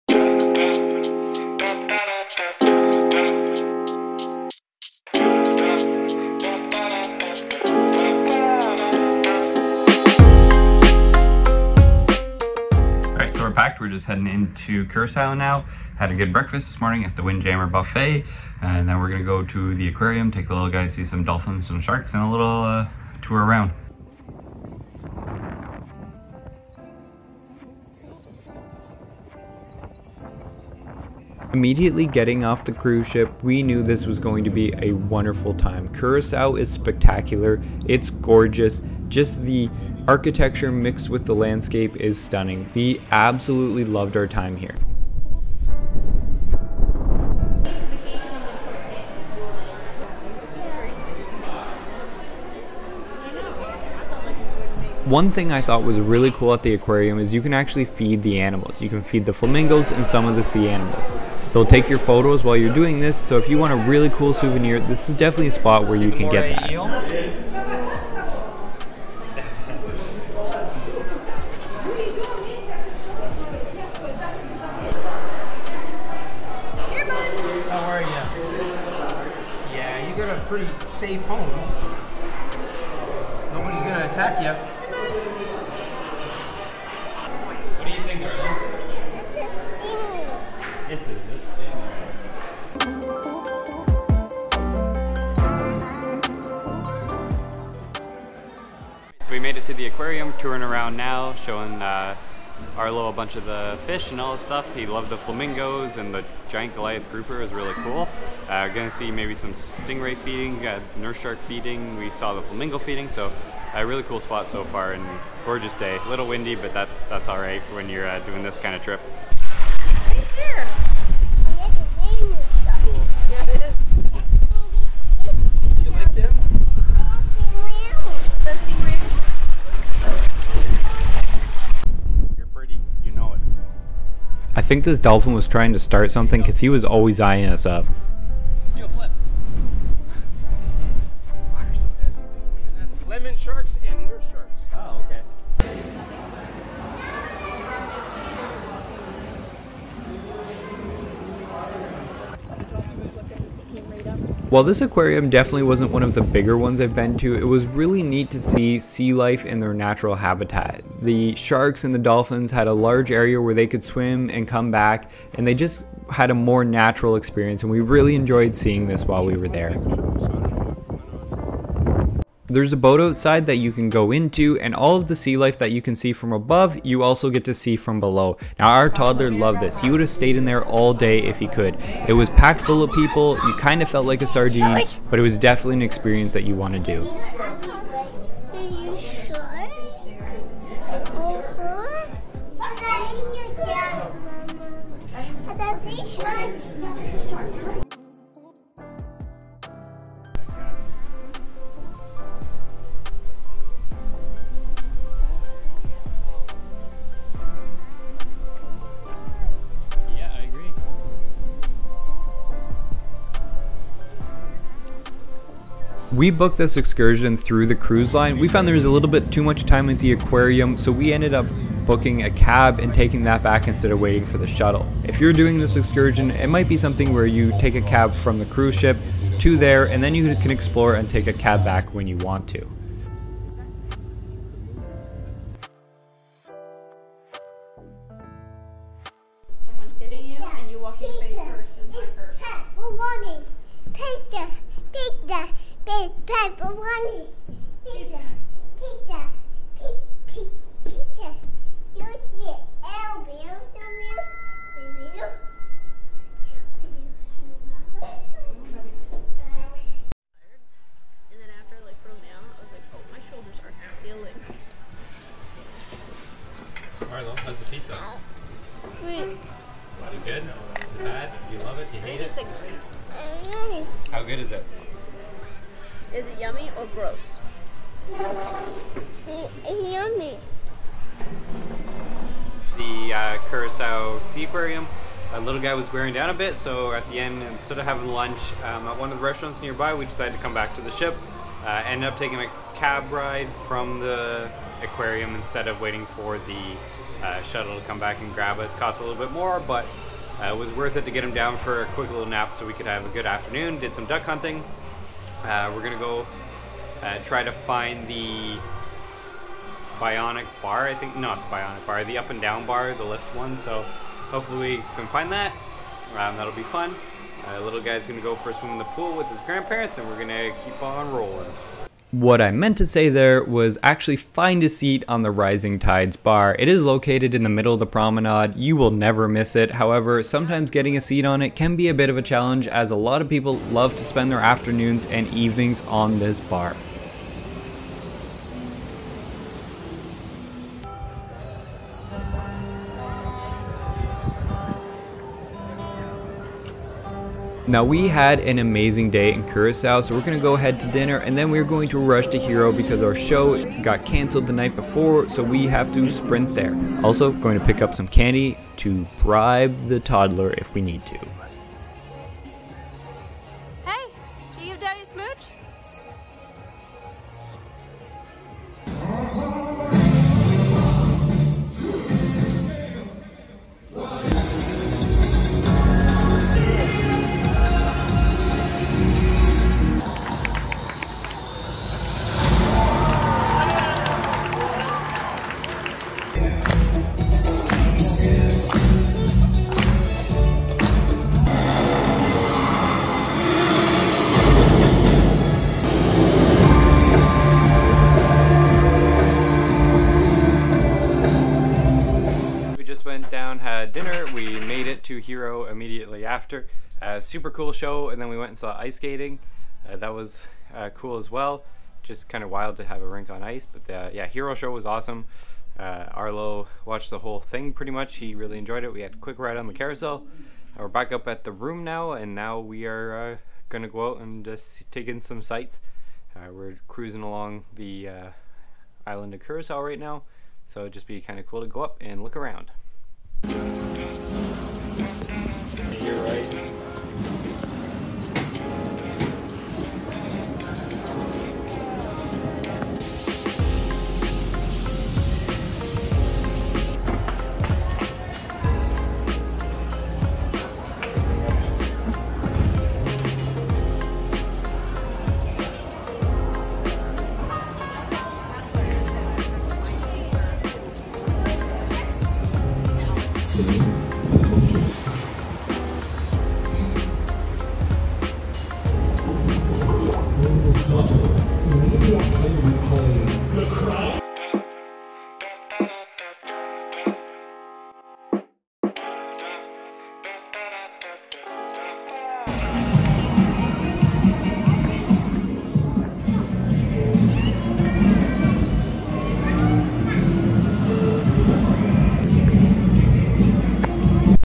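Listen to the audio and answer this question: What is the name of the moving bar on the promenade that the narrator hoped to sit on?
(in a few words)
Rising Tides.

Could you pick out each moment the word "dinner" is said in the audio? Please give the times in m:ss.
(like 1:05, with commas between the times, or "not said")
5:50, 6:43.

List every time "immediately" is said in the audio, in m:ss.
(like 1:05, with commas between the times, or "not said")
0:31, 6:45.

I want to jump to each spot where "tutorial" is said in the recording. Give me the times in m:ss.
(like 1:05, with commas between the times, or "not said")
not said.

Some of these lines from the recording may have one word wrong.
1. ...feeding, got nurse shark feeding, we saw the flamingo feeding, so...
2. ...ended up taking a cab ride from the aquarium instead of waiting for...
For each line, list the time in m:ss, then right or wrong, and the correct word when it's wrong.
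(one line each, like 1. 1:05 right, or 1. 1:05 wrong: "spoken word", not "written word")
1. 1:50 right
2. 4:51 right.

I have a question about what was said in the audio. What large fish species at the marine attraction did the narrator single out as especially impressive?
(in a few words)
Goliath grouper.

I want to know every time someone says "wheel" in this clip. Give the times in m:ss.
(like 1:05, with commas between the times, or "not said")
not said.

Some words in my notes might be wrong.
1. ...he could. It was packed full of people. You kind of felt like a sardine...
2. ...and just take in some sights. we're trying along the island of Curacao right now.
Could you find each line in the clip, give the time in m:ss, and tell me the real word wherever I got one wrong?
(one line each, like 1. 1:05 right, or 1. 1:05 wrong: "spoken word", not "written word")
1. 3:01 right
2. 7:04 wrong: "cruising", not "trying".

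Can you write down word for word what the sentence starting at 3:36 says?
We booked this excursion through the cruise line.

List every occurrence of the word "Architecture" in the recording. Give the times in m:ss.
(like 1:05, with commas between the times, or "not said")
0:40.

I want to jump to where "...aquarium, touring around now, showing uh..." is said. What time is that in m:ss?
1:39.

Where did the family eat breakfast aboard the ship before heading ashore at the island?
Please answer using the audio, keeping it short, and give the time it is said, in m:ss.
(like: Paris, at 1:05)
Windjammer Buffet, at 0:17.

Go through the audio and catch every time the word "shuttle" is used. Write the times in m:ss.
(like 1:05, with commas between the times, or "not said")
3:44, 4:57.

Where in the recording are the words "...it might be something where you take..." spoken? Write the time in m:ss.
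3:46.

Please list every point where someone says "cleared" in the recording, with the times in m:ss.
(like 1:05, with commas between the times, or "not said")
not said.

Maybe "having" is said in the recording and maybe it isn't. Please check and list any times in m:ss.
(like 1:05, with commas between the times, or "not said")
4:47.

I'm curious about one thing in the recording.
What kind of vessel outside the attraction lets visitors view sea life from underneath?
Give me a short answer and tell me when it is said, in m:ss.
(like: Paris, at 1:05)
A boat, at 2:52.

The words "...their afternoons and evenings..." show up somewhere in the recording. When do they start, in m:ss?
5:34.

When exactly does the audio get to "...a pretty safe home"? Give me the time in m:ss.
1:20.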